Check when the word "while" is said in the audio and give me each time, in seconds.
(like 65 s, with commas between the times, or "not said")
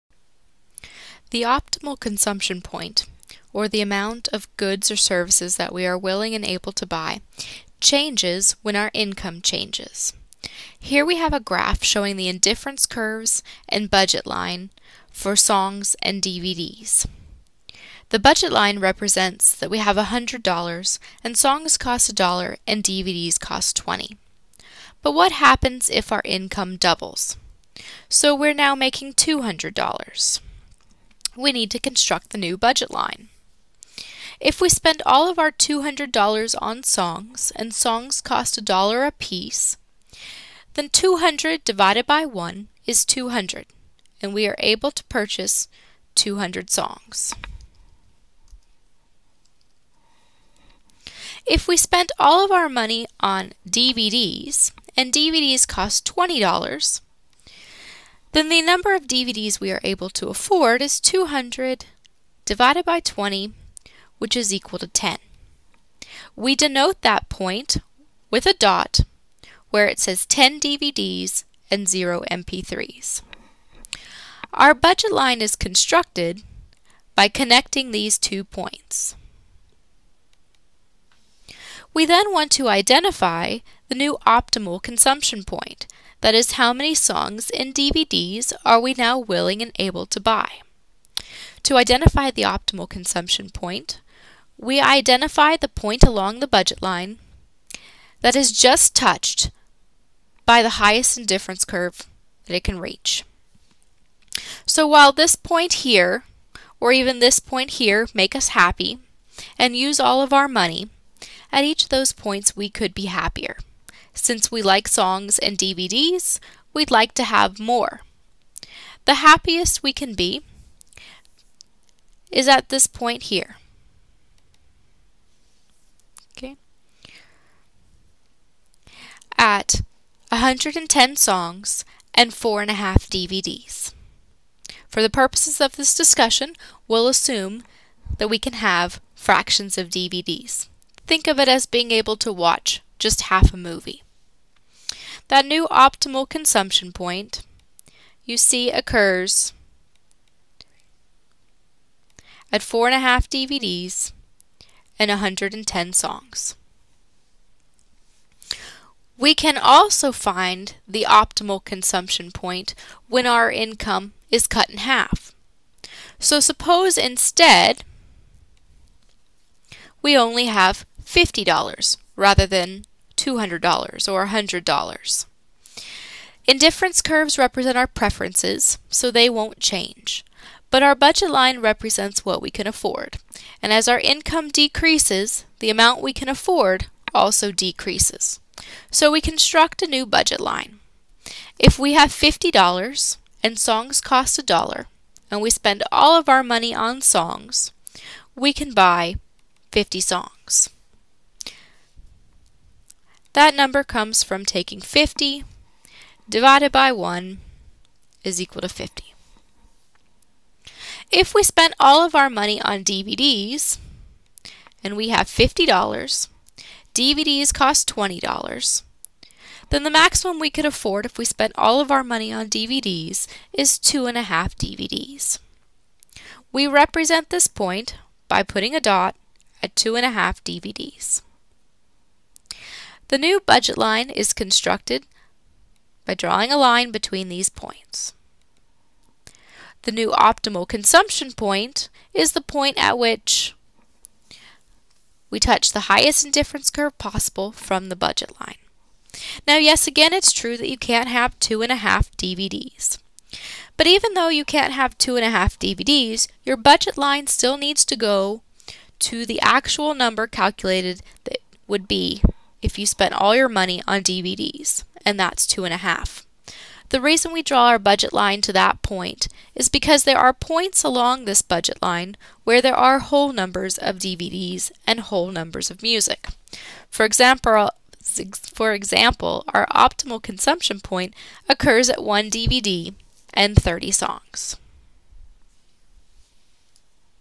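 104 s.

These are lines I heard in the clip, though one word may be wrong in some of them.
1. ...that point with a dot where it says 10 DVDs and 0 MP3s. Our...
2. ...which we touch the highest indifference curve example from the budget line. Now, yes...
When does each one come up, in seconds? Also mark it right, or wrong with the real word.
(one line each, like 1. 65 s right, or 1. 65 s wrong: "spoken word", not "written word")
1. 67 s right
2. 242 s wrong: "possible", not "example".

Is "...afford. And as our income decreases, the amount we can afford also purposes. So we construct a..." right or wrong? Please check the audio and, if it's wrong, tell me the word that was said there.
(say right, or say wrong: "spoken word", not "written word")
wrong: "decreases", not "purposes".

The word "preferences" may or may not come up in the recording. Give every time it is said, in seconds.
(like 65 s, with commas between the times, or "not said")
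177 s.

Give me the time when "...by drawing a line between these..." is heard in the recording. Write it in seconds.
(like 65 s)
236 s.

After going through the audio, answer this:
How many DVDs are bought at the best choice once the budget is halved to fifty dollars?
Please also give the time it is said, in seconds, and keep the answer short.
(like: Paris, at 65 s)
1, at 282 s.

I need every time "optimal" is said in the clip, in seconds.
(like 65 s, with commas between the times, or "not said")
1 s, 84 s, 92 s, 145 s, 161 s, 240 s, 279 s.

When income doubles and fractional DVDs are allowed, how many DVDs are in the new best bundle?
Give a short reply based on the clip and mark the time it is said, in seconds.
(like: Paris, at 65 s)
4.5, at 132 s.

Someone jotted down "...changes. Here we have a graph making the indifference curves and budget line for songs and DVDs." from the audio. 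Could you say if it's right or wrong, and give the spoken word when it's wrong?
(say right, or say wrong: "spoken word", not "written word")
wrong: "showing", not "making".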